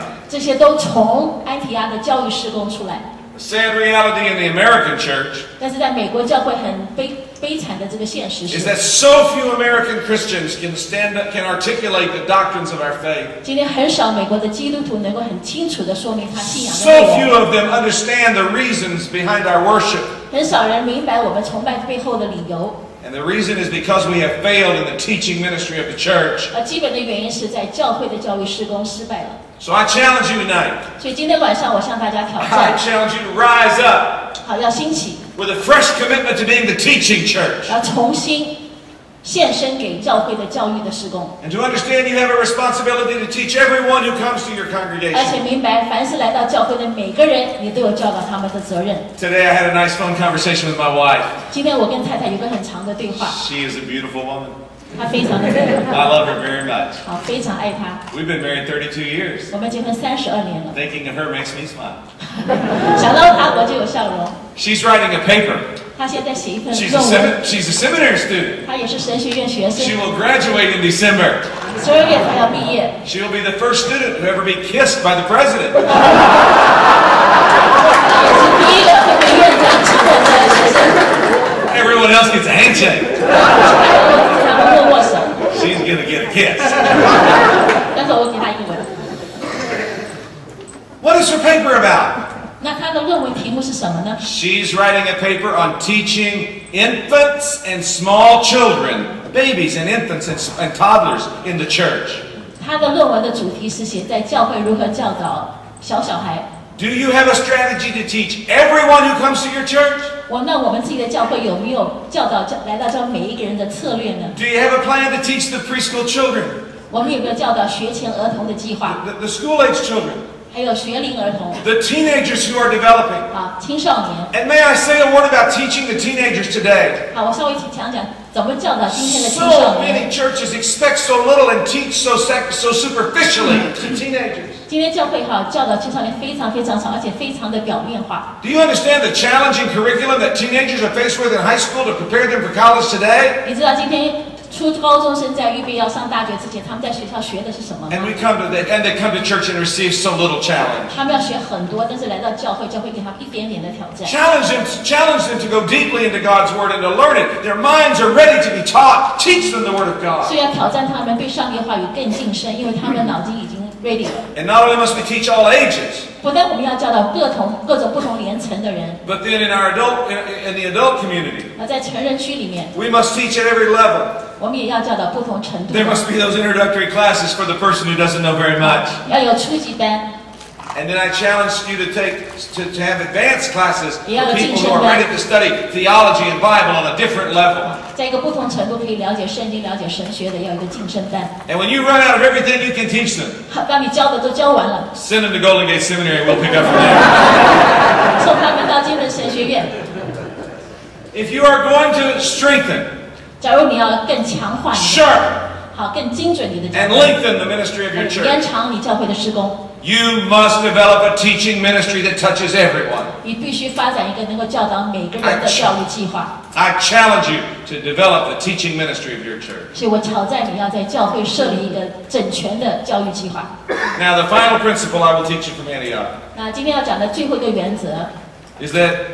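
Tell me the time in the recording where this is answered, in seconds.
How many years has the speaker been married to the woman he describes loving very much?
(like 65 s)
58 s.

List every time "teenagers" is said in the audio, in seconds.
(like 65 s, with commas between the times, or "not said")
121 s, 125 s, 133 s, 140 s.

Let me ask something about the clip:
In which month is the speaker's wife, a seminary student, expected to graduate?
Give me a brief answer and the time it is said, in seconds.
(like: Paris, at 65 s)
December, at 70 s.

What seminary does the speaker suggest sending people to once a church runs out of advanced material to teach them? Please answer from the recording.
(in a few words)
Golden Gate Seminary.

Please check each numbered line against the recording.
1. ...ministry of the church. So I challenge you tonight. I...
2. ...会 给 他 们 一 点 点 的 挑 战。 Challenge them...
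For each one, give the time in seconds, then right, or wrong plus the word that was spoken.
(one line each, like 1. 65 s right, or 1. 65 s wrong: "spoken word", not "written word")
1. 25 s right
2. 152 s right.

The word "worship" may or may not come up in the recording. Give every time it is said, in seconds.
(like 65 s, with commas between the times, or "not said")
19 s.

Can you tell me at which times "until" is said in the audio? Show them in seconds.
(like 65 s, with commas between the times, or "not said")
not said.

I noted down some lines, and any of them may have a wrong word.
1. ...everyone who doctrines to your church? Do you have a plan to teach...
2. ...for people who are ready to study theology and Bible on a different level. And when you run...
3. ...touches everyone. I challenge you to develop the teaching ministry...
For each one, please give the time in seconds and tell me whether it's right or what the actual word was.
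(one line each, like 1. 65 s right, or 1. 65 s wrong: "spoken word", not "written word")
1. 108 s wrong: "comes", not "doctrines"
2. 183 s right
3. 212 s right.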